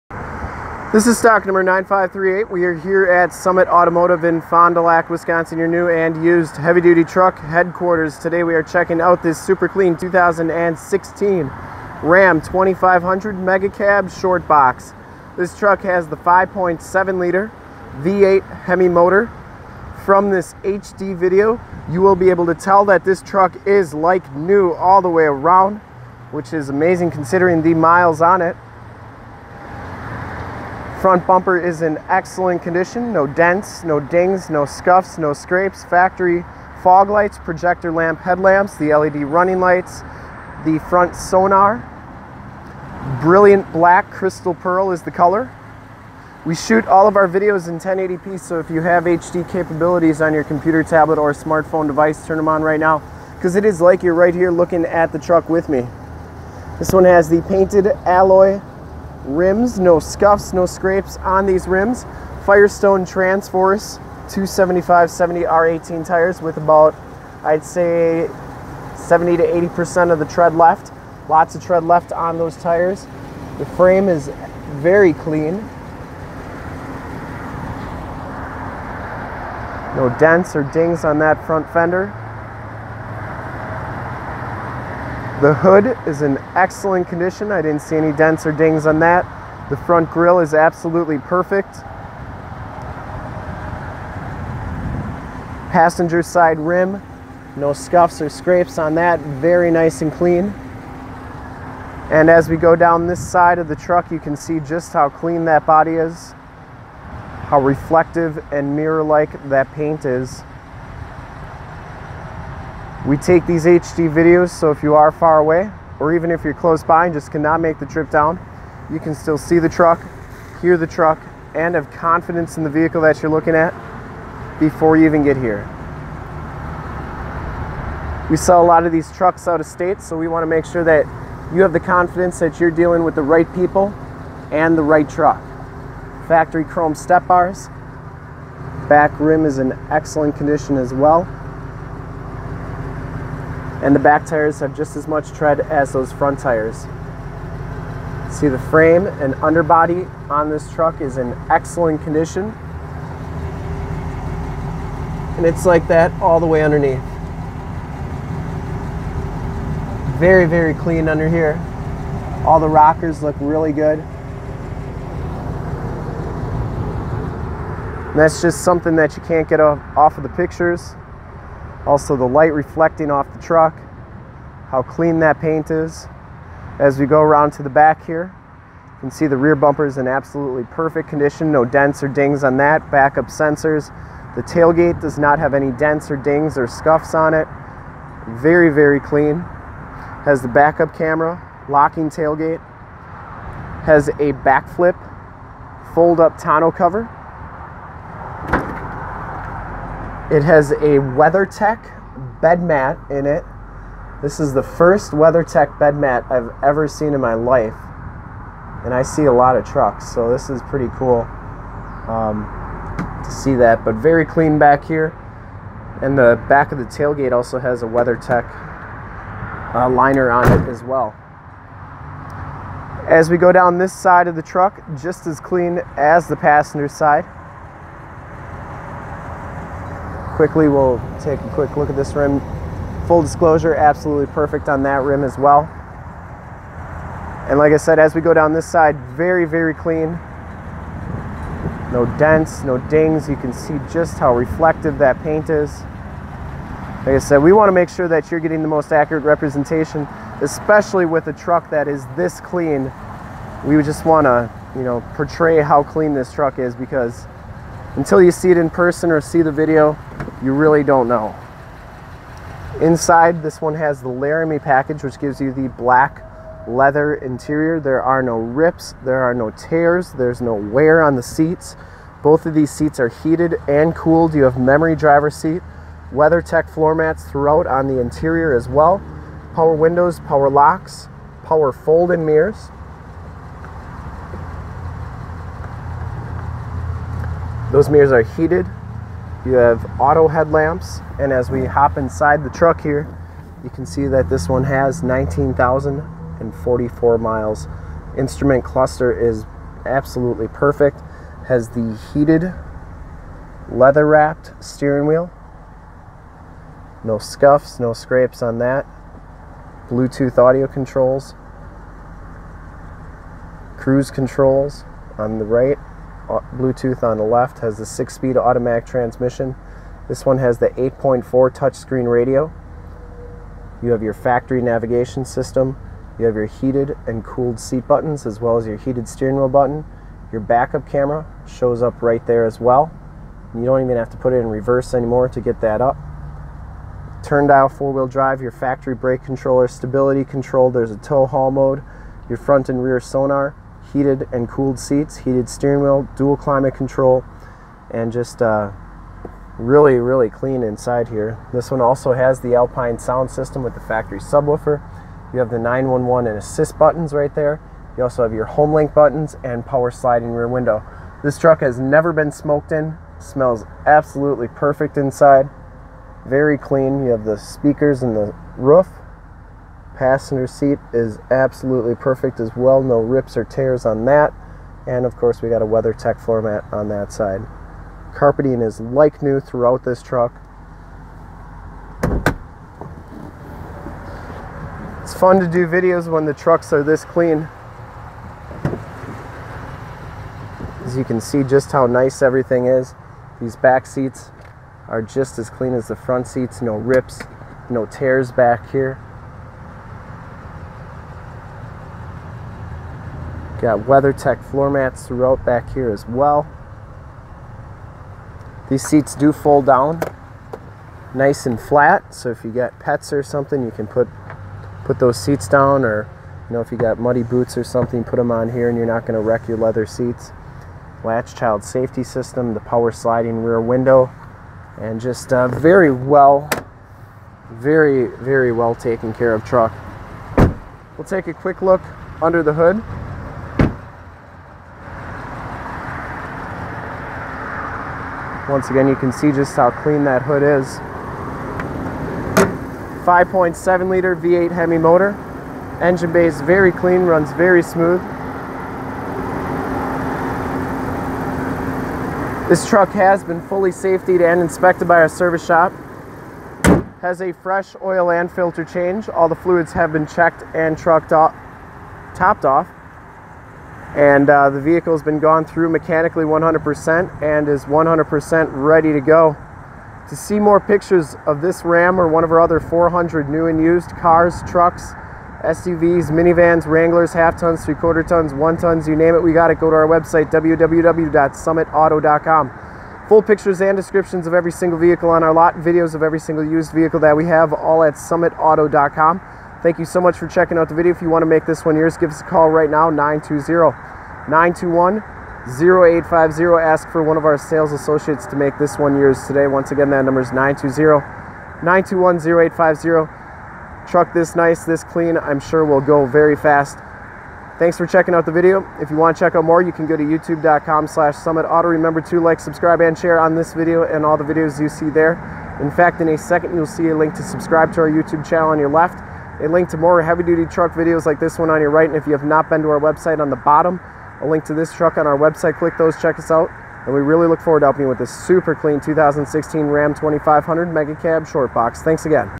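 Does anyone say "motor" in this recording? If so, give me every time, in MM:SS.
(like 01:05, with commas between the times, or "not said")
00:18, 07:24.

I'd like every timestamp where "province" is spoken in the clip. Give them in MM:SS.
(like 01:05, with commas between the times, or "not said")
not said.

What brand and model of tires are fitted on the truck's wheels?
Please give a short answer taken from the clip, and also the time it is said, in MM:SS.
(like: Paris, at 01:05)
Firestone Transforce, at 01:02.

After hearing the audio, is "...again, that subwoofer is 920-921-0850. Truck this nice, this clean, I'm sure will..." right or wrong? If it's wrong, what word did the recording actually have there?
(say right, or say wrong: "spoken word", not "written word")
wrong: "number", not "subwoofer".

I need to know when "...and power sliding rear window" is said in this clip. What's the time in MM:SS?
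05:59.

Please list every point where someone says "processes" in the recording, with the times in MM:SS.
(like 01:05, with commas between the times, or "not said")
not said.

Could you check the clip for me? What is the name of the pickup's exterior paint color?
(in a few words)
Brilliant black crystal pearl.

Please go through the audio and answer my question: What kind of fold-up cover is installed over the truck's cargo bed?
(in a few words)
Bakflip.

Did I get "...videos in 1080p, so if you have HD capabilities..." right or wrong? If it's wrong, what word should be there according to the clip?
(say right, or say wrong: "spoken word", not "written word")
right.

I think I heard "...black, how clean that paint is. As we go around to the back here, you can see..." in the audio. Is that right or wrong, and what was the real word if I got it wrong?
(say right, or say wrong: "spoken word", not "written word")
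wrong: "truck", not "black".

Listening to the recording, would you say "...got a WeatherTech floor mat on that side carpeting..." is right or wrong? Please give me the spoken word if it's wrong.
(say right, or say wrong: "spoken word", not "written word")
right.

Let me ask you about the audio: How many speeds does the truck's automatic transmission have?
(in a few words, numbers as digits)
6.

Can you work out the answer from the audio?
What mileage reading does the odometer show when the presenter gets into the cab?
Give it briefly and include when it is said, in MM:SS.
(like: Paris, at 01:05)
19,044, at 04:55.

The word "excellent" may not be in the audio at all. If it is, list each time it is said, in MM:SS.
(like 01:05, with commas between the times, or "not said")
00:32, 01:26, 02:19, 02:31.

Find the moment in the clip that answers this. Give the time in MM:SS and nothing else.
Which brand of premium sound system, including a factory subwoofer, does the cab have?
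05:52.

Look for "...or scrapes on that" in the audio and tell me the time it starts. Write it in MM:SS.
01:38.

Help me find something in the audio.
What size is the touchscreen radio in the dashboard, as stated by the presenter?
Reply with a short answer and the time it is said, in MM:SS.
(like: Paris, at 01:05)
8.4, at 05:20.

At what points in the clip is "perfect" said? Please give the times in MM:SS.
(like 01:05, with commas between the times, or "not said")
01:31, 03:00, 03:54, 05:00, 06:04, 06:11.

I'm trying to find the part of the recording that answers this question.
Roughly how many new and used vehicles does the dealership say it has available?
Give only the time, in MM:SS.
07:52.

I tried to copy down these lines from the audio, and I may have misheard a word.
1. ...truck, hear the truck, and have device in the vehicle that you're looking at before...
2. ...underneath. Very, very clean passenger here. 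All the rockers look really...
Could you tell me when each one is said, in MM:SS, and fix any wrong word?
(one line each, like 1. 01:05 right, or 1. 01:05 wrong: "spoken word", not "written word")
1. 01:59 wrong: "confidence", not "device"
2. 02:36 wrong: "under", not "passenger".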